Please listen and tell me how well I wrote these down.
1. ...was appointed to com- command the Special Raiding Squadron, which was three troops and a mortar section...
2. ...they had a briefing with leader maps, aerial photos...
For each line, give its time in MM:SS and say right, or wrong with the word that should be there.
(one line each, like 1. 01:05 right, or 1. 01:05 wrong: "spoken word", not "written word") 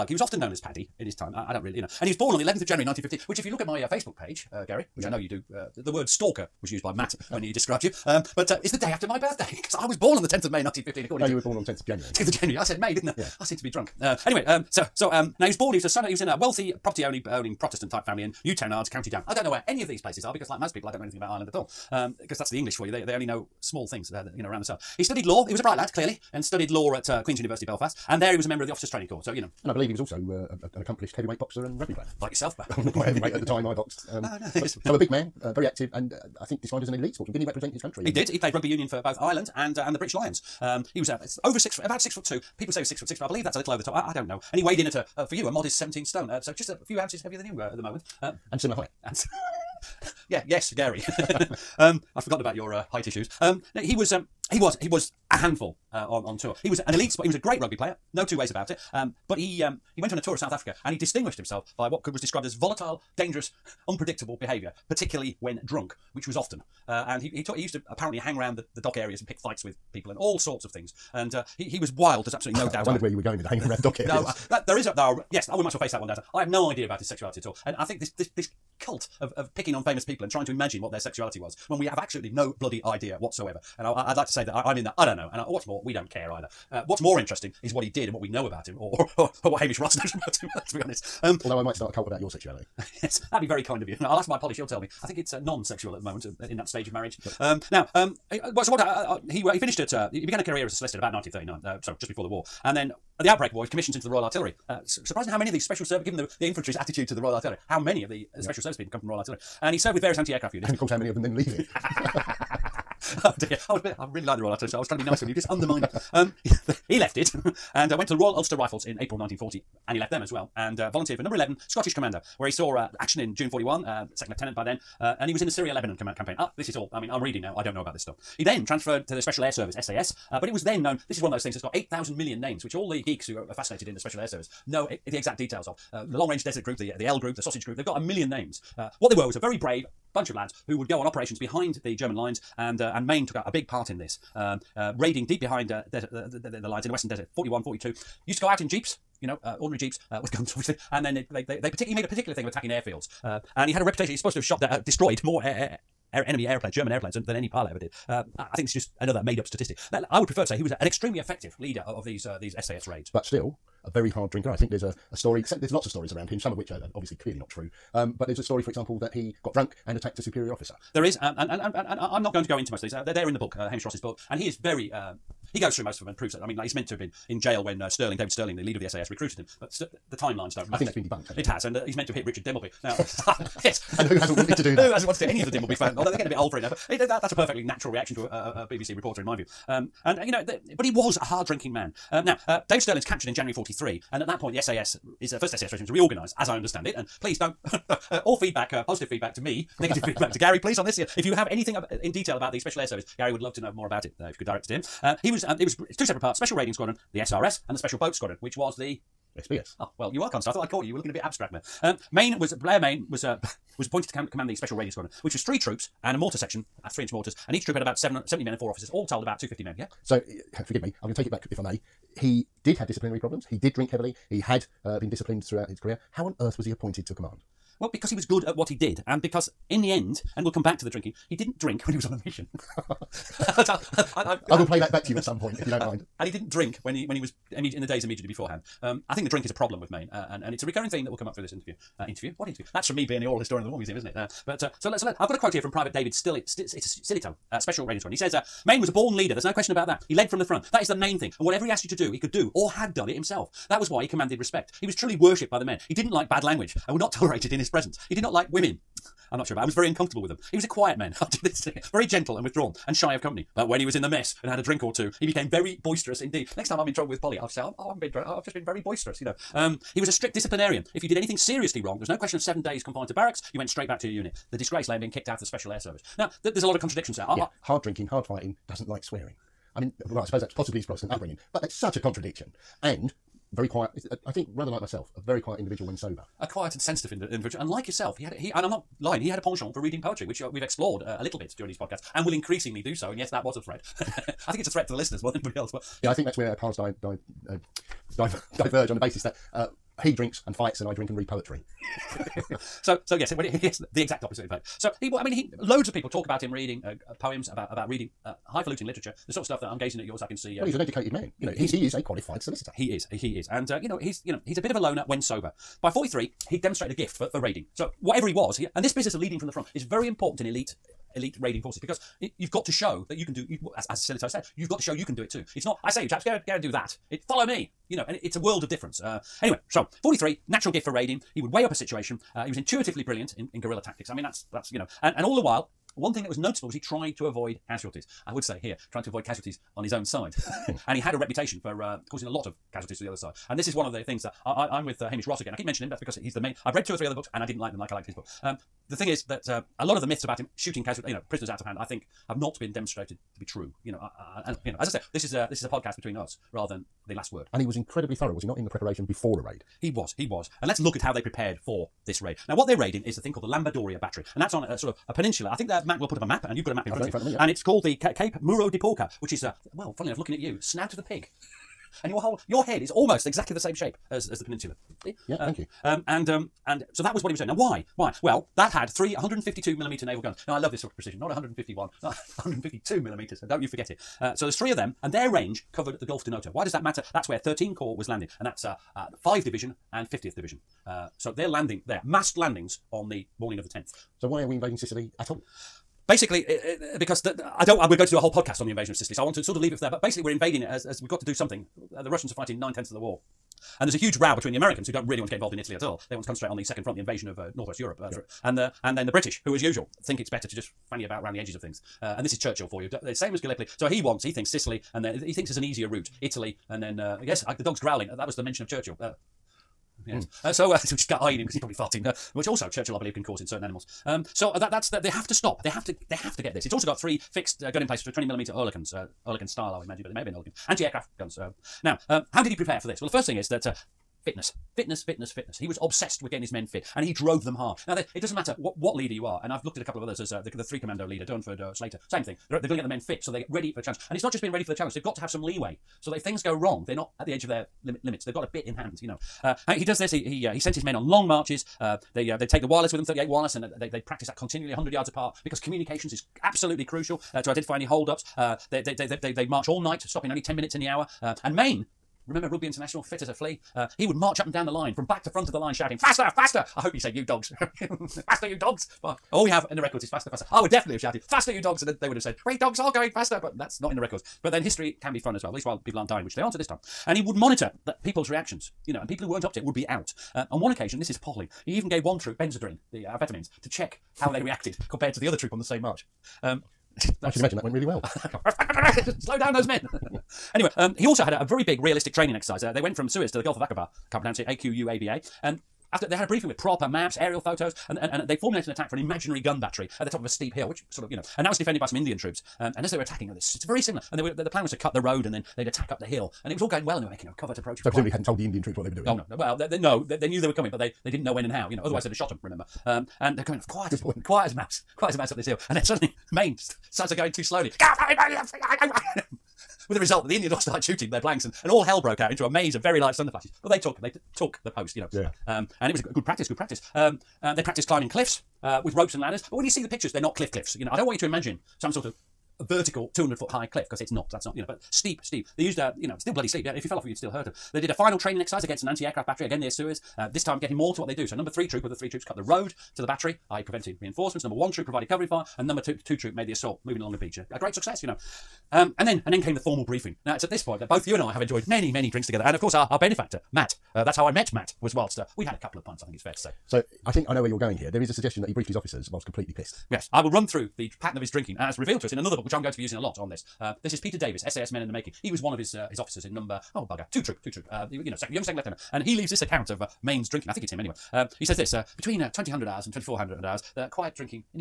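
1. 03:33 right
2. 08:16 wrong: "proper", not "leader".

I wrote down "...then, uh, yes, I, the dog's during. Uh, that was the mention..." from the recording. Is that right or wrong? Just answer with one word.
wrong.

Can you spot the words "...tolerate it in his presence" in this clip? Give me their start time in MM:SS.
04:17.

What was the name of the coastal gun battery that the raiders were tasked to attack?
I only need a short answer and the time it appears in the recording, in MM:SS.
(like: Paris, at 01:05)
Lambadoria Battery, at 06:03.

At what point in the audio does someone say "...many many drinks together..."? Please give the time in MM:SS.
09:11.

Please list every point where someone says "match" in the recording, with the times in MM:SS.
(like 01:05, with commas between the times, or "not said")
03:00.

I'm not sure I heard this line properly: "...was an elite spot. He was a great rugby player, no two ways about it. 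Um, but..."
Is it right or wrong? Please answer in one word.
right.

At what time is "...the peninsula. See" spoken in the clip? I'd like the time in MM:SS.
06:14.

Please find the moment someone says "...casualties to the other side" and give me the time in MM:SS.
05:42.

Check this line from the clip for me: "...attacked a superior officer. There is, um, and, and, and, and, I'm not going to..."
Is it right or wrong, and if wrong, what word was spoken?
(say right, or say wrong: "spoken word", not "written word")
right.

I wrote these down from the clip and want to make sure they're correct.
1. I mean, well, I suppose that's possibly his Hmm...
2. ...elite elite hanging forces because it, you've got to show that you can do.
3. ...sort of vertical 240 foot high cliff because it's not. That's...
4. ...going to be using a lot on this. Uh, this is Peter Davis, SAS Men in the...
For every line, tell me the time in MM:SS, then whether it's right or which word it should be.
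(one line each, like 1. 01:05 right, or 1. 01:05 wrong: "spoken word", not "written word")
1. 04:39 wrong: "Protestant", not "Hmm"
2. 05:20 wrong: "raiding", not "hanging"
3. 08:51 wrong: "200", not "240"
4. 09:22 right.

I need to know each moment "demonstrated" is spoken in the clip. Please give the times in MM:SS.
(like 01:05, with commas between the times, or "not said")
05:16, 05:52.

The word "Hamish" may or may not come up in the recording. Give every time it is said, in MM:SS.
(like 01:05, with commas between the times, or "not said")
01:29, 02:53, 05:45.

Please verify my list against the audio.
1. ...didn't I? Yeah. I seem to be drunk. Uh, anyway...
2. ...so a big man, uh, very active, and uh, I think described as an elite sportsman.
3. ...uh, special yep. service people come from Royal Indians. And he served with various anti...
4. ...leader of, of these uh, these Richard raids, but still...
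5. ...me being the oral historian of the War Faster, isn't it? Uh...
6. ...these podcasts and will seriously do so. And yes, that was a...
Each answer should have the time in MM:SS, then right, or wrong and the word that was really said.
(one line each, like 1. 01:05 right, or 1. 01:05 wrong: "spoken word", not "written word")
1. 00:12 right
2. 00:34 right
3. 01:48 wrong: "Artillery", not "Indians"
4. 02:41 wrong: "SAS", not "Richard"
5. 04:02 wrong: "Museum", not "Faster"
6. 04:51 wrong: "increasingly", not "seriously".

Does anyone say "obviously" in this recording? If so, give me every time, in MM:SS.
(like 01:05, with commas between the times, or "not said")
02:30, 02:46.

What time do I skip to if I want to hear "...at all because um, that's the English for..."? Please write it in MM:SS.
00:21.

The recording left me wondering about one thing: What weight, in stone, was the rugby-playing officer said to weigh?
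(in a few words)
17 stone.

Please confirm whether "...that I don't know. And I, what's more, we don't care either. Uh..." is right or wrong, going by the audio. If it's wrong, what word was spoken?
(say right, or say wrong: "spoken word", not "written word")
right.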